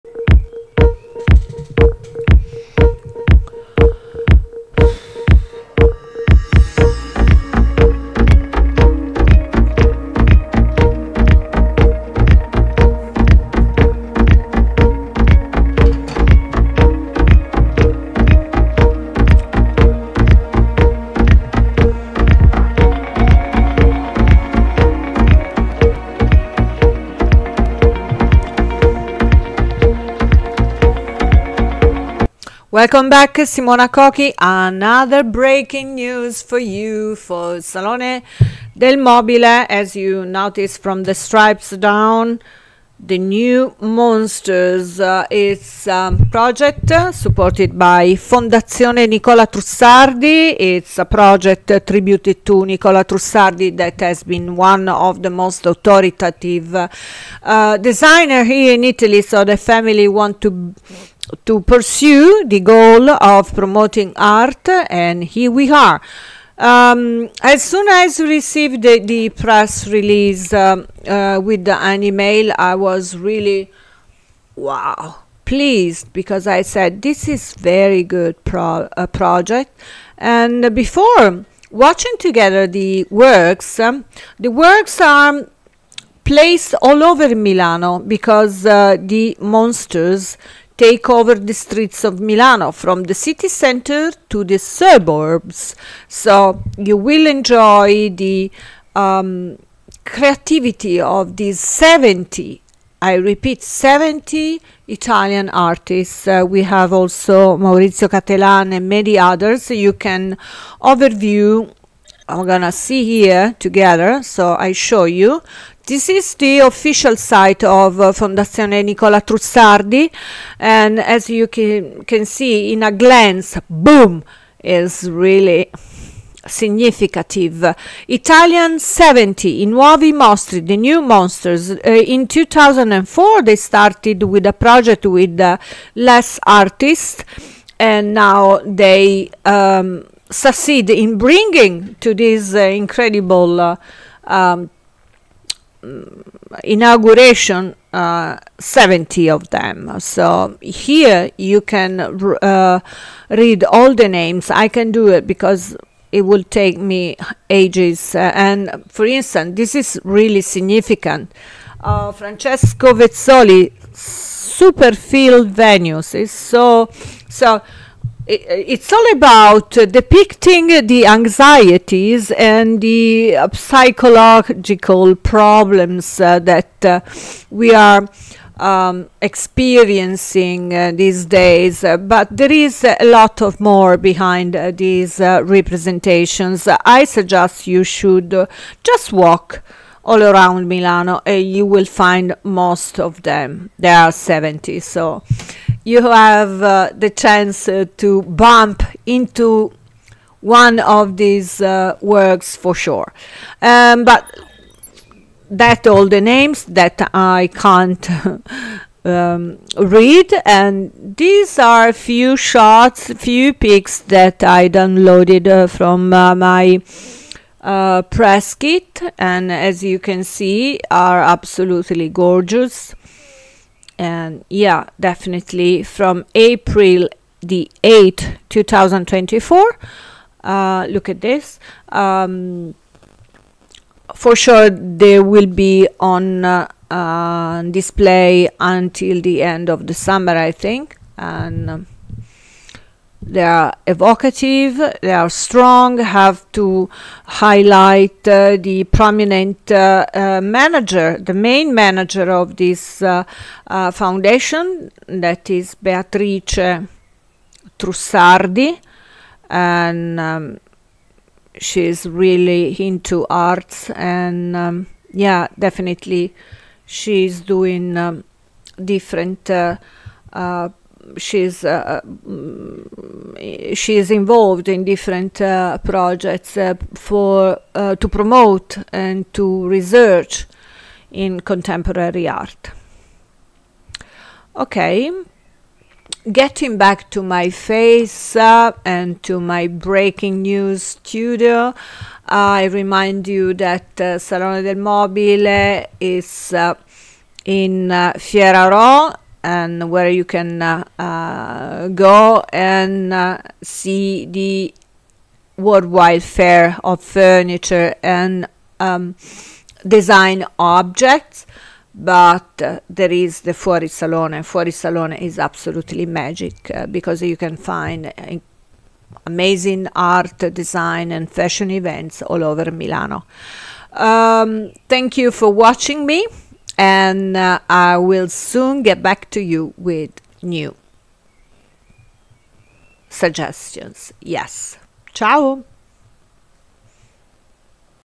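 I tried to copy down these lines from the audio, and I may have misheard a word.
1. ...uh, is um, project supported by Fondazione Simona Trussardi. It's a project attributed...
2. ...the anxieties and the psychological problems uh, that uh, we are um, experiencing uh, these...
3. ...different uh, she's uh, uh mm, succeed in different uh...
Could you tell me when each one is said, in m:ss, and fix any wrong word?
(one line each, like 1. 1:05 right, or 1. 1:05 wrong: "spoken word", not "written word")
1. 0:44 wrong: "Nicola", not "Simona"
2. 2:50 right
3. 4:28 wrong: "involved", not "succeed".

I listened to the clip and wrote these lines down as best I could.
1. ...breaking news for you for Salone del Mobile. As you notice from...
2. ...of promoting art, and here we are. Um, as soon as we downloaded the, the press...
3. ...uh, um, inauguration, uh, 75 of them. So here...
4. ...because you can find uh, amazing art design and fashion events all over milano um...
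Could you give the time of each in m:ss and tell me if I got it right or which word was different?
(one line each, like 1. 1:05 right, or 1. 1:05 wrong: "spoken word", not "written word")
1. 0:35 right
2. 1:03 wrong: "received", not "downloaded"
3. 2:23 wrong: "70", not "75"
4. 5:16 right.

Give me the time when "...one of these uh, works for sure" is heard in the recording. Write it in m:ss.
3:20.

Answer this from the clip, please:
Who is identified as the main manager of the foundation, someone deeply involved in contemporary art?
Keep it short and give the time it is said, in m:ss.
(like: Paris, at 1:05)
Beatrice Trussardi, at 4:15.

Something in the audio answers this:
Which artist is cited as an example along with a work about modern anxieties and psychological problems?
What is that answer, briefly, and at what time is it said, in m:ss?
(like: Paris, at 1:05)
Francesco Vezzoli, at 2:42.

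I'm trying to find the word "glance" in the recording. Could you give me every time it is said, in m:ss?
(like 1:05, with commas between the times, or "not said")
2:02.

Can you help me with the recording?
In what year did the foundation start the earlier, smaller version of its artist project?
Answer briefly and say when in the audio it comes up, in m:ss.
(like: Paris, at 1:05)
2004, at 2:12.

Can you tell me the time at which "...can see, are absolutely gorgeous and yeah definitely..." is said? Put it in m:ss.
3:39.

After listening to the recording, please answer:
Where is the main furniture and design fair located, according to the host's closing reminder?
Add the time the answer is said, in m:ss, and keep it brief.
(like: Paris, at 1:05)
Fiera Rho, at 4:58.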